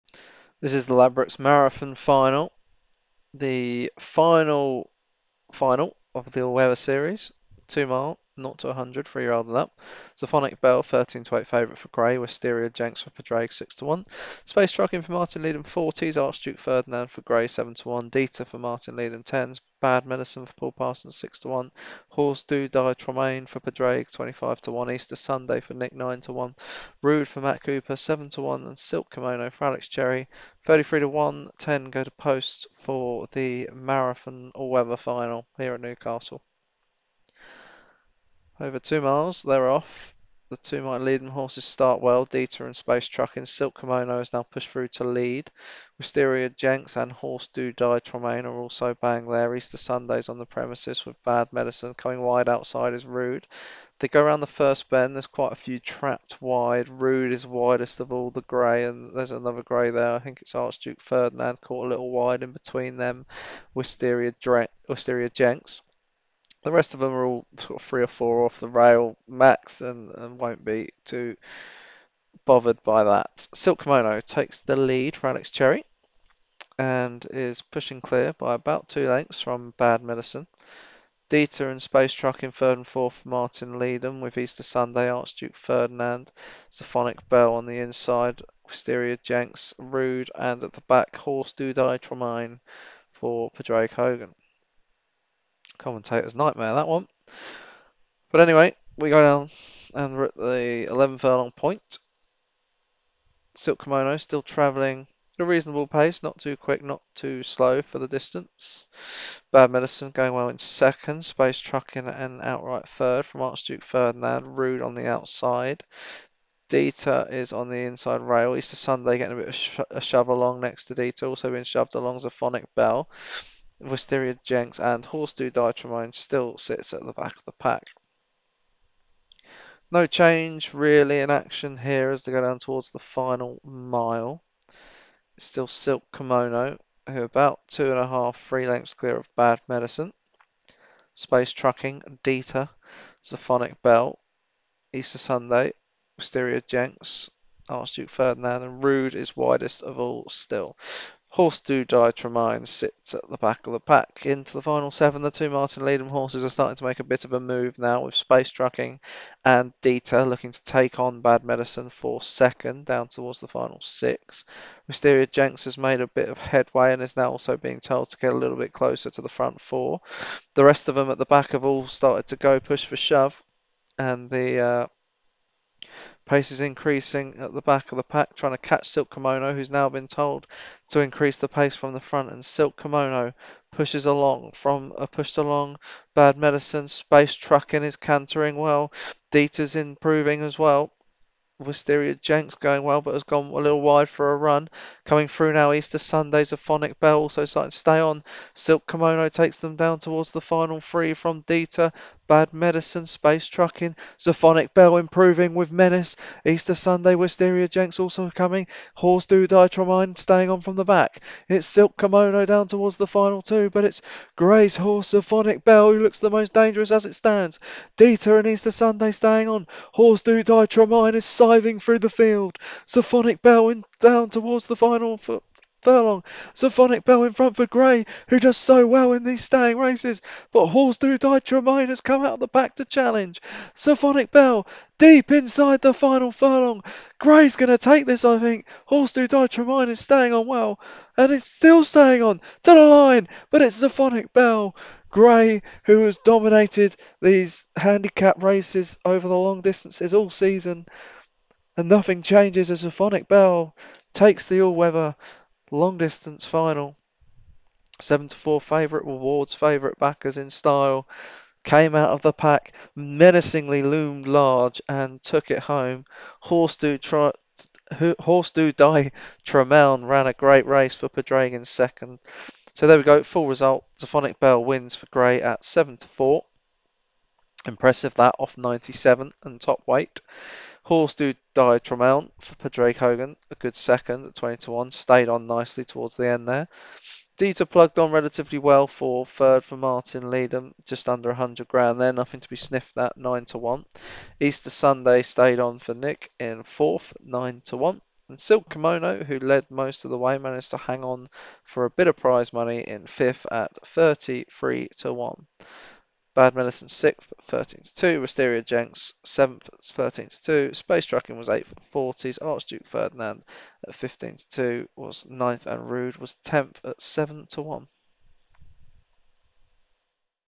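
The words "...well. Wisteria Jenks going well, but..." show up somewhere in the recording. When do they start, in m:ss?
3:10.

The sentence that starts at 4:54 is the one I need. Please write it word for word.
Easter Sunday stayed on for Nick in fourth, 9 to 1.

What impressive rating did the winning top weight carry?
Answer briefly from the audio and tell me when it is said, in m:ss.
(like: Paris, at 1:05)
97, at 4:38.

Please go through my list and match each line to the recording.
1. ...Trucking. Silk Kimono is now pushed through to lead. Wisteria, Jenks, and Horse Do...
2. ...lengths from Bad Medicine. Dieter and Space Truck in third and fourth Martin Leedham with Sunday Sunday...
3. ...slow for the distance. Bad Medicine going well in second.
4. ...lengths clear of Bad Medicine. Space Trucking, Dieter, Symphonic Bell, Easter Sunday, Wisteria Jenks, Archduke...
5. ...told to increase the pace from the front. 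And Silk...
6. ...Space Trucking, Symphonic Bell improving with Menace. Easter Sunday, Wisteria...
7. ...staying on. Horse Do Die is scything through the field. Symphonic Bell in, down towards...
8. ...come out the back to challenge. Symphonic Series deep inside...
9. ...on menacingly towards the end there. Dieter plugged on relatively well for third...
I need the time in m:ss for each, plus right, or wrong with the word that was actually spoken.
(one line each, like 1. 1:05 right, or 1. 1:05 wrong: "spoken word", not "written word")
1. 0:43 right
2. 1:19 wrong: "Easter", not "Sunday"
3. 1:47 right
4. 2:18 right
5. 3:00 right
6. 3:23 right
7. 3:39 right
8. 3:52 wrong: "Bell", not "Series"
9. 4:45 wrong: "nicely", not "menacingly".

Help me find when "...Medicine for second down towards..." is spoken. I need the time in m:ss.
2:41.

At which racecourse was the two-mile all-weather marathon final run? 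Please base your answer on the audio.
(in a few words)
Newcastle.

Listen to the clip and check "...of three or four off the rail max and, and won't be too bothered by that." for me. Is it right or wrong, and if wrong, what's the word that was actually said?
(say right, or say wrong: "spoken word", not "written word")
right.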